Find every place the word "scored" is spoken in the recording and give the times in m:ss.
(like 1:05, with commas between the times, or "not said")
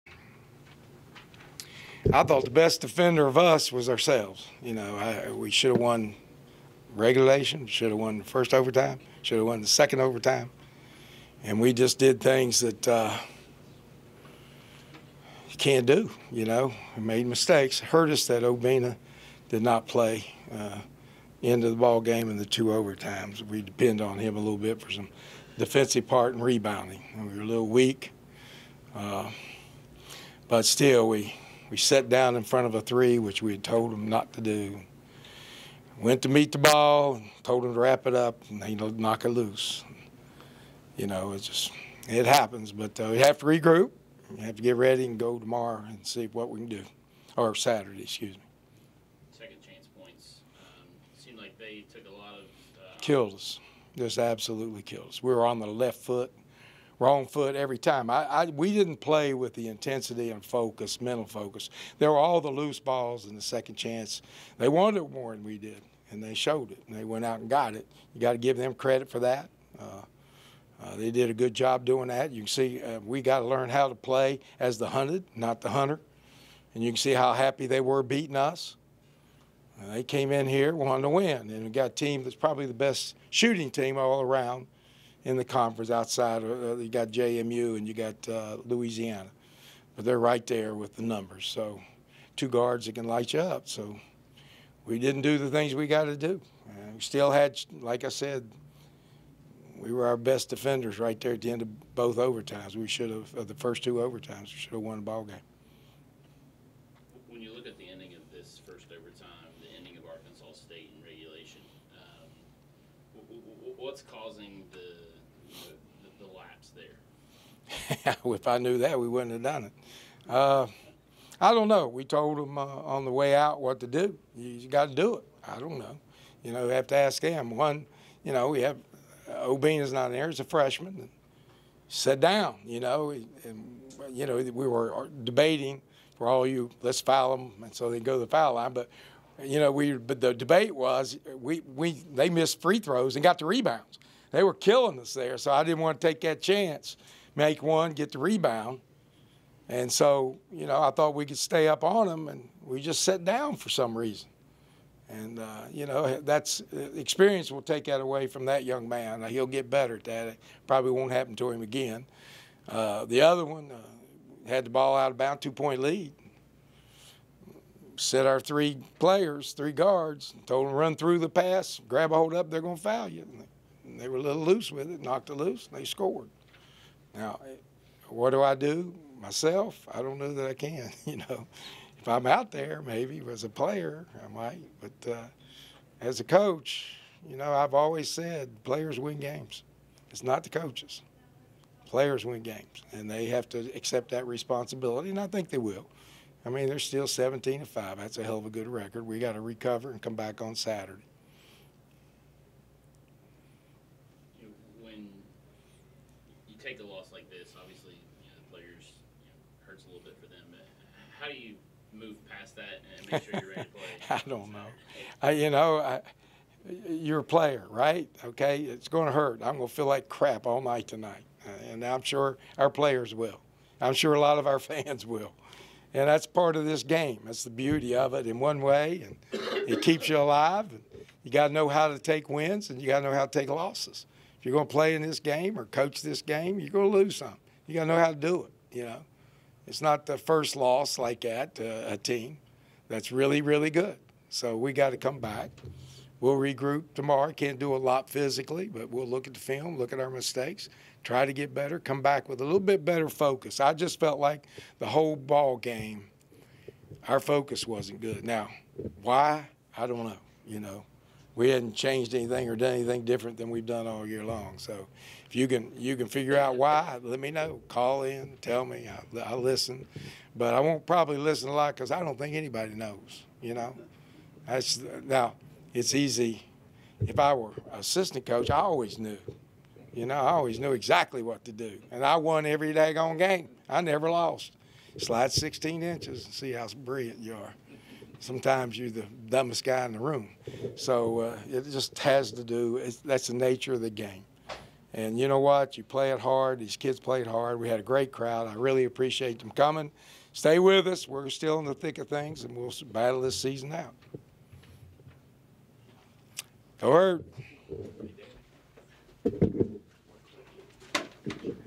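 2:55.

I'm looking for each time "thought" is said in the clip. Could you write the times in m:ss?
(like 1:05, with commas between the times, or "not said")
0:02, 2:30.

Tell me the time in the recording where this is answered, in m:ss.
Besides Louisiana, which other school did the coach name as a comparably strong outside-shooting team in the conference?
1:27.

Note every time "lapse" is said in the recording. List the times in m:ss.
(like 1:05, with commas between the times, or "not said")
1:56.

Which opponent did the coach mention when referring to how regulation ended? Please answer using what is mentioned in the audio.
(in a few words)
Arkansas State.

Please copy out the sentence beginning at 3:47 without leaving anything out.
That's the beauty of it in one way.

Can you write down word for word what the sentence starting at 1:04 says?
They wanted it more than we did, and they showed it.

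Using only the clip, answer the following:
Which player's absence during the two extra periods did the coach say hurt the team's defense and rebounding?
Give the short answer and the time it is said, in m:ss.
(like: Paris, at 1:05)
Obinna, at 0:18.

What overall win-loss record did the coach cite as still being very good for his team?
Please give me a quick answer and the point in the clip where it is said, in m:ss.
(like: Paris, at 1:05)
17-5, at 3:17.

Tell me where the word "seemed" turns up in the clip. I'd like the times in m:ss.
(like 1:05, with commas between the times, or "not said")
0:51.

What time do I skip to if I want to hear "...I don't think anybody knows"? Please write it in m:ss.
4:31.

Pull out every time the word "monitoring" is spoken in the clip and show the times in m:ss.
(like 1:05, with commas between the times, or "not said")
not said.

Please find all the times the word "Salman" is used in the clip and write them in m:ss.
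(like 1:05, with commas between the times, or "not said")
not said.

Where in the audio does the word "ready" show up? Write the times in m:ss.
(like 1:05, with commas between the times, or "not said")
0:44, 3:33.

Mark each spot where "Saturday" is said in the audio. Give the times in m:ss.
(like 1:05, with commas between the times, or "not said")
0:47, 3:20.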